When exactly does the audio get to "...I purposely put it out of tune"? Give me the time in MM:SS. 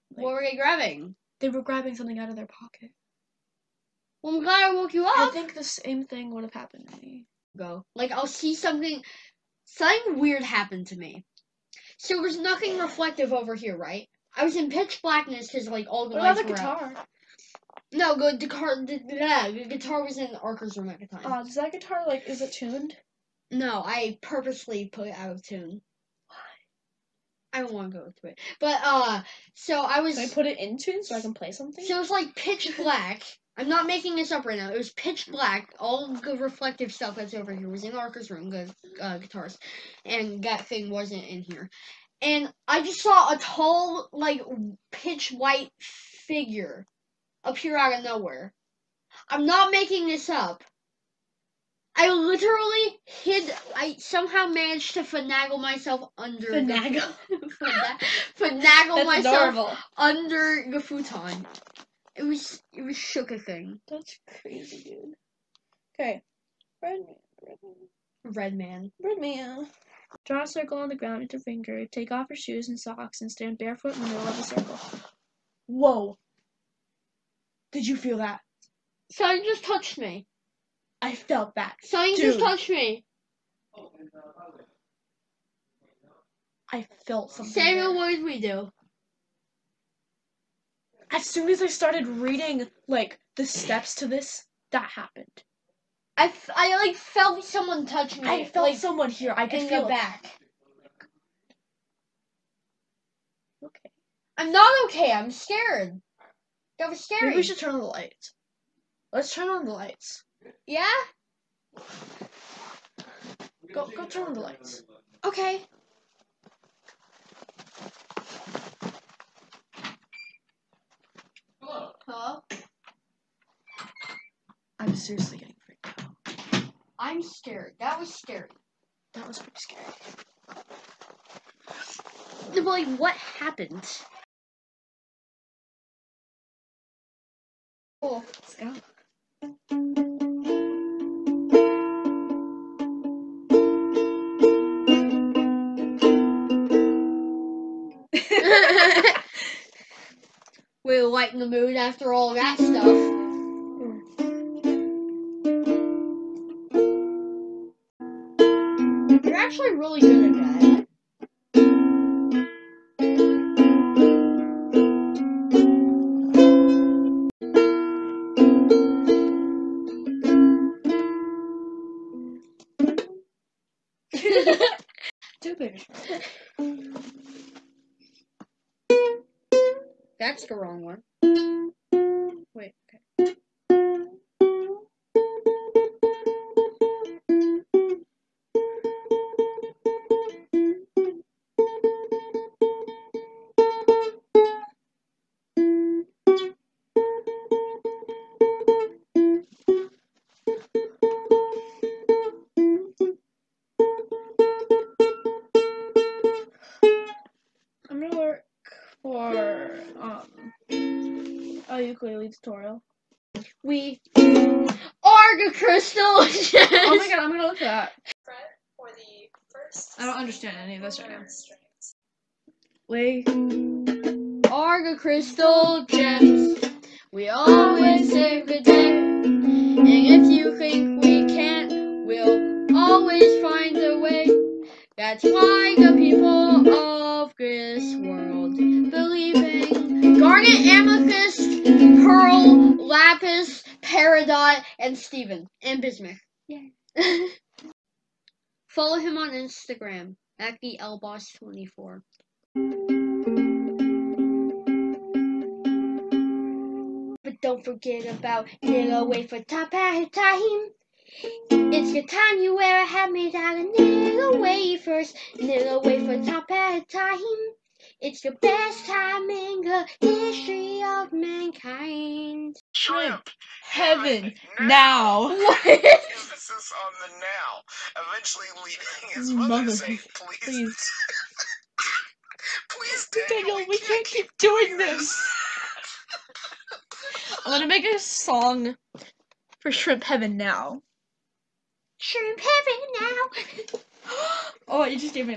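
00:23.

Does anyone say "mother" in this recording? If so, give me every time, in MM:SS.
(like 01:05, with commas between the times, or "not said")
04:39.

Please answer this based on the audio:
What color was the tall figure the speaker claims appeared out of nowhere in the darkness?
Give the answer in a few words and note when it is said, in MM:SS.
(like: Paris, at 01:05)
White, at 00:44.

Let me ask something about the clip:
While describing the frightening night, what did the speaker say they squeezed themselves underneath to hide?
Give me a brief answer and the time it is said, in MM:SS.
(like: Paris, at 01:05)
the futon, at 01:00.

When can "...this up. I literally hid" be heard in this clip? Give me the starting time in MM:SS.
00:50.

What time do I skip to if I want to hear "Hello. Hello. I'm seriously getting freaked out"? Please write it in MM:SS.
02:01.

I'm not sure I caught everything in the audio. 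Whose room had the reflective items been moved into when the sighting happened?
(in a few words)
Arca's room.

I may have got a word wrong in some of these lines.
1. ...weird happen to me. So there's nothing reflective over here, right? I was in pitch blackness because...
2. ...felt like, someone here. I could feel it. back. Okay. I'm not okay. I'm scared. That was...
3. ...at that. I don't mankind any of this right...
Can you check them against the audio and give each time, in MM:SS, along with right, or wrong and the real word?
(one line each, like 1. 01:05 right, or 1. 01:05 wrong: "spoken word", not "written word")
1. 00:10 right
2. 01:38 right
3. 03:37 wrong: "understand", not "mankind".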